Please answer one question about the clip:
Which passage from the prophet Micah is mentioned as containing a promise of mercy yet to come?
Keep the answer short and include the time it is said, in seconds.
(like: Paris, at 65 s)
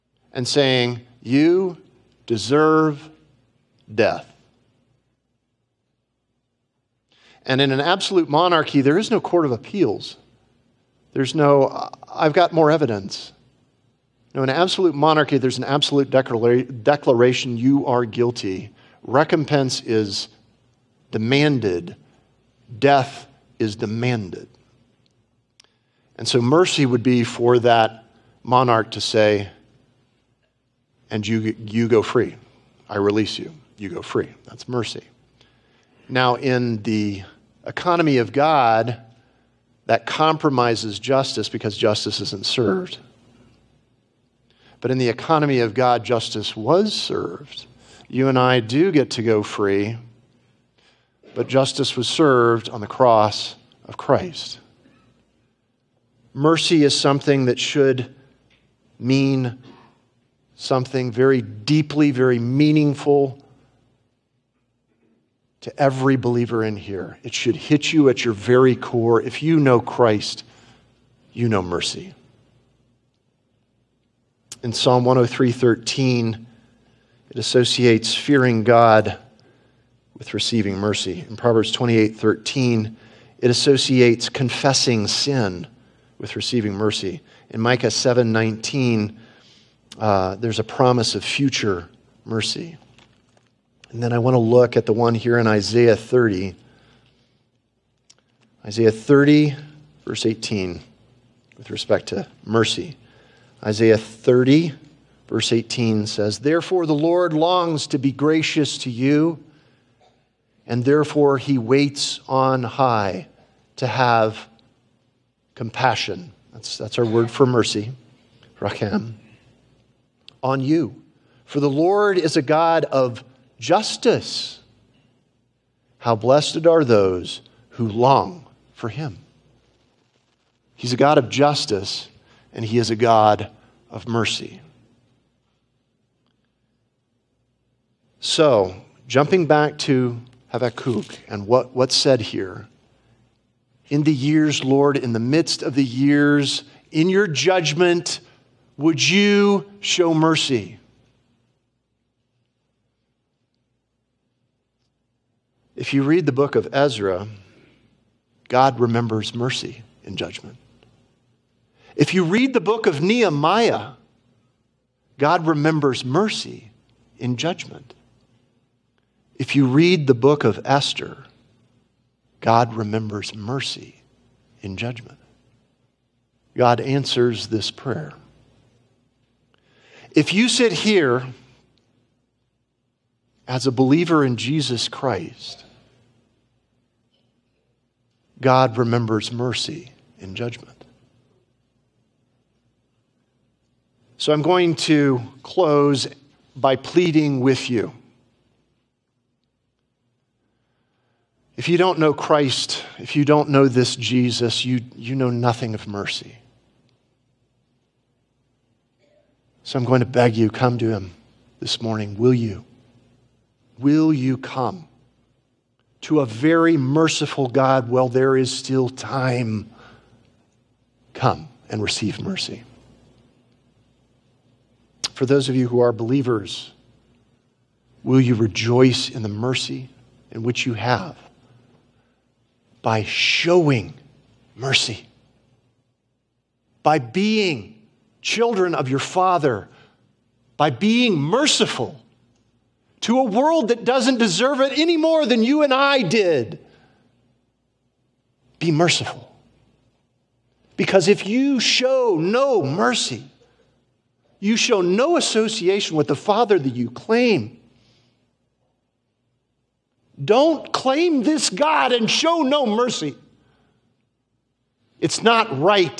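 Micah 7:19, at 87 s.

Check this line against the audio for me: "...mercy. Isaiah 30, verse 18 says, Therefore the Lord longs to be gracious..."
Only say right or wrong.
right.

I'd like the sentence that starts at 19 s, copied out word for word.
Recompense is demanded, death is demanded.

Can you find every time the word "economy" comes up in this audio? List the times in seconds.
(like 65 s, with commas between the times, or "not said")
37 s, 45 s.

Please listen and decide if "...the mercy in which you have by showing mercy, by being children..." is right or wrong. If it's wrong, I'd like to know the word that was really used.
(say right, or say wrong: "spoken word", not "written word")
right.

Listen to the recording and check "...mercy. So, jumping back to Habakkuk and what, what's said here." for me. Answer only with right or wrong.
right.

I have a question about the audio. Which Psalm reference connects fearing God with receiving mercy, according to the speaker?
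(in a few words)
Psalm 103:13.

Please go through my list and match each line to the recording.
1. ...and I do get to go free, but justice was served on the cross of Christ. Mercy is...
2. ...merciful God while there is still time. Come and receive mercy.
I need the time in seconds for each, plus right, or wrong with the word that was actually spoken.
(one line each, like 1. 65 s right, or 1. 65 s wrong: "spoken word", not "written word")
1. 48 s right
2. 216 s right.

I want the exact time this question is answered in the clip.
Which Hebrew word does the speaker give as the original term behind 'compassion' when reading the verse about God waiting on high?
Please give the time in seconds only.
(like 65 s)
118 s.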